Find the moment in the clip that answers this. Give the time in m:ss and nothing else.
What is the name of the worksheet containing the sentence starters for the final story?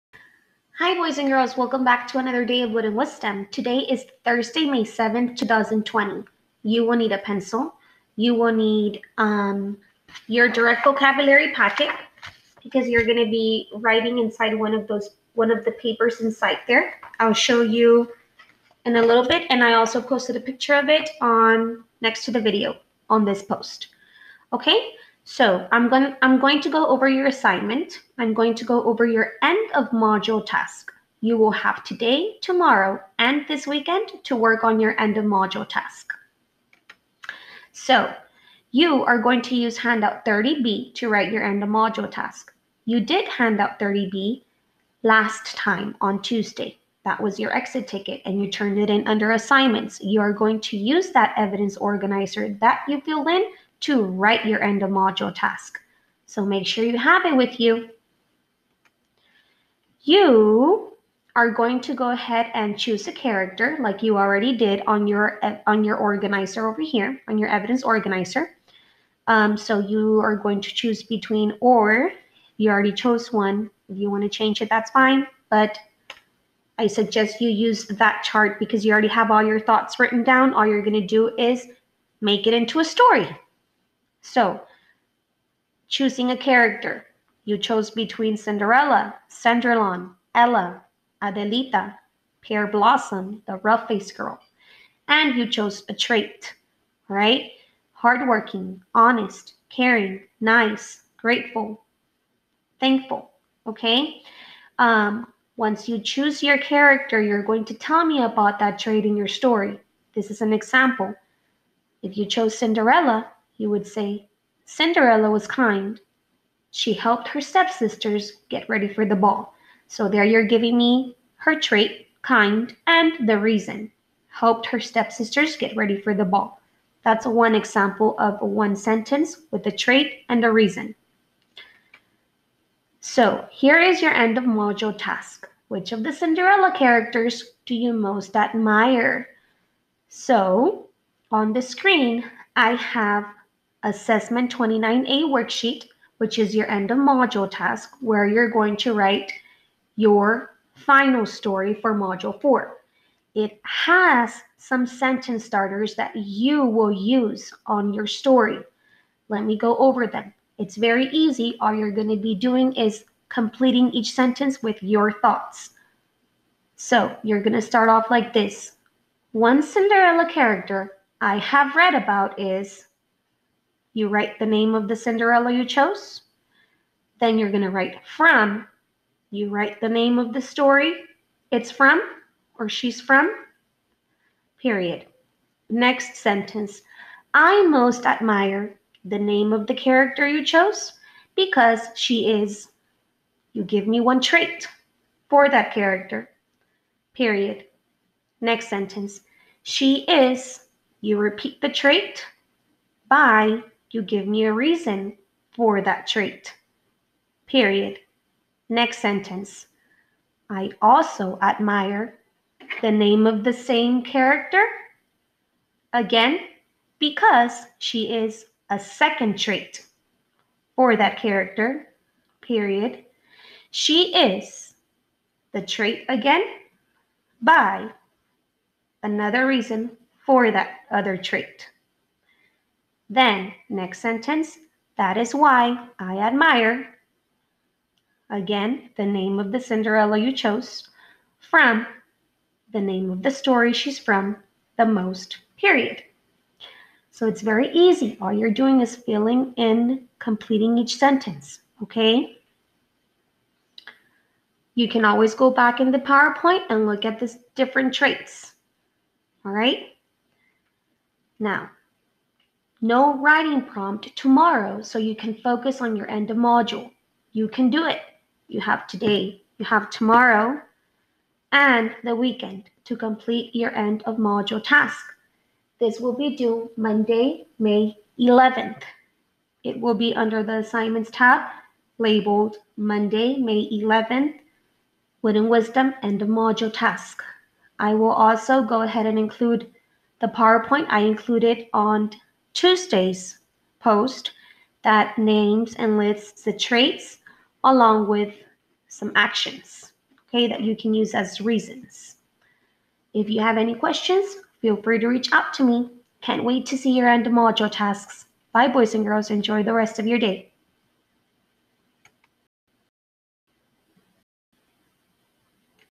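2:23.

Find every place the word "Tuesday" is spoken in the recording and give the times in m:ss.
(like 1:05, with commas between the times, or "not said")
0:46, 4:52.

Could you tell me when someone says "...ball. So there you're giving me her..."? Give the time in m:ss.
1:59.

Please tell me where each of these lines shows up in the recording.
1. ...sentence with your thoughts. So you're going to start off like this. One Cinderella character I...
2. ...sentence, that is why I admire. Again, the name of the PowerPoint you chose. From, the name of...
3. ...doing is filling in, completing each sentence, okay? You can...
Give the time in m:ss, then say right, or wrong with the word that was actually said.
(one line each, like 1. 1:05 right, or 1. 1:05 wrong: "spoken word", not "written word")
1. 2:44 right
2. 3:53 wrong: "Cinderella", not "PowerPoint"
3. 4:08 right.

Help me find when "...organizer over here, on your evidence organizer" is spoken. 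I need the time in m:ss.
1:05.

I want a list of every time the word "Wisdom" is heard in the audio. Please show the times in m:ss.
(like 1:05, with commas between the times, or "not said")
0:02, 4:45.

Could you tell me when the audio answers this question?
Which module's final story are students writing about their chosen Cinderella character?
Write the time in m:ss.
2:31.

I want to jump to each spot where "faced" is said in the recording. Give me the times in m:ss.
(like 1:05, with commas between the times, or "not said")
1:33.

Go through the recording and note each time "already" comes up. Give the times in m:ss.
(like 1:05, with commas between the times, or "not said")
1:04, 1:12, 1:18.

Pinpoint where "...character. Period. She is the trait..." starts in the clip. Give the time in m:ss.
3:41.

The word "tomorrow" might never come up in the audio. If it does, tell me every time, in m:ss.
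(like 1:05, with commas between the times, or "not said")
0:32, 4:24, 4:29.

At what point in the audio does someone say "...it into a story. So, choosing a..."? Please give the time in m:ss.
1:22.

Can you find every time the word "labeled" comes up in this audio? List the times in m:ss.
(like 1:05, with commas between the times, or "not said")
4:41.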